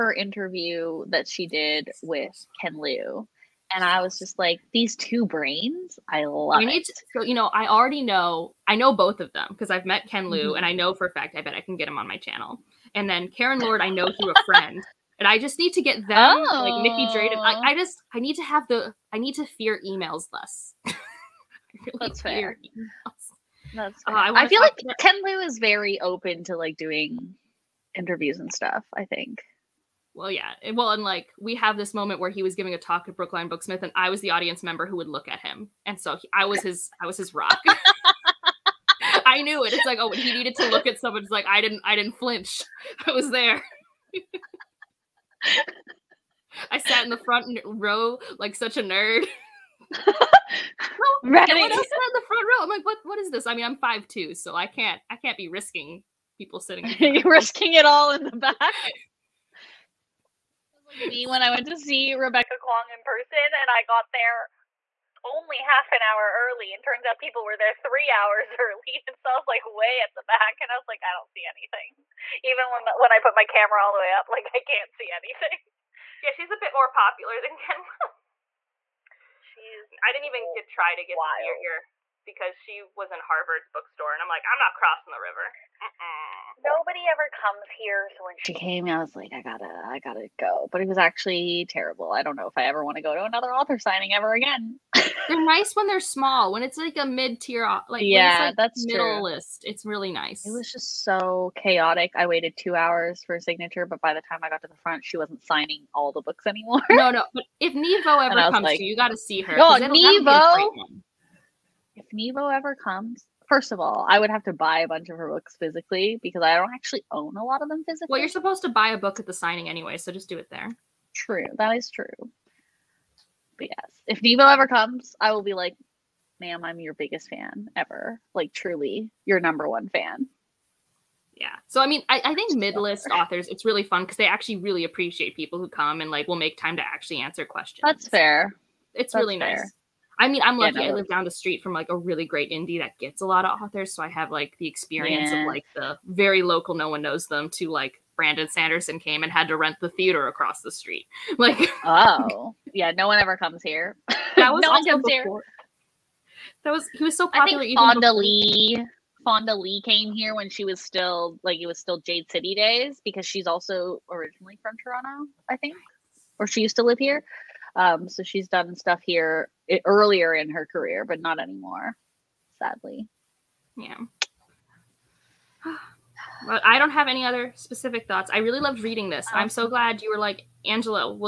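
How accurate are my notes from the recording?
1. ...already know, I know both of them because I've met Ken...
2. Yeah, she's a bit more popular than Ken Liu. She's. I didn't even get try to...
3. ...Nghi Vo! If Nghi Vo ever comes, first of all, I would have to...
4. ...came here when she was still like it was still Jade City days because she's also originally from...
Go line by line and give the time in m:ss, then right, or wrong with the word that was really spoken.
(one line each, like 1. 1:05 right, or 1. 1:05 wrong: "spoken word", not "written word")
1. 0:07 right
2. 1:16 right
3. 1:49 right
4. 2:39 right.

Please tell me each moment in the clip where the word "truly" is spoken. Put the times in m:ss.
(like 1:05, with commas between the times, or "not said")
2:08.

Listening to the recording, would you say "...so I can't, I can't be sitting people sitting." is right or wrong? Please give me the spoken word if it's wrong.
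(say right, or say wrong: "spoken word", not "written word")
wrong: "risking", not "sitting".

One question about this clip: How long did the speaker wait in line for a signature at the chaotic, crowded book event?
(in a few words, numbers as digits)
2 hours.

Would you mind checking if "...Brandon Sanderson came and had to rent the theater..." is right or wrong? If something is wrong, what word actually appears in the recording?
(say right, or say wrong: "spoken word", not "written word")
right.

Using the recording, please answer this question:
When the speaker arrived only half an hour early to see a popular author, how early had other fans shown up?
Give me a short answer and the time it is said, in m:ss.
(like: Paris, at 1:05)
3 hours, at 1:07.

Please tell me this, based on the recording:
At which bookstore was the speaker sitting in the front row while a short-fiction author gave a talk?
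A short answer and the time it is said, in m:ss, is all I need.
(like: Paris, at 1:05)
Brookline Booksmith, at 0:33.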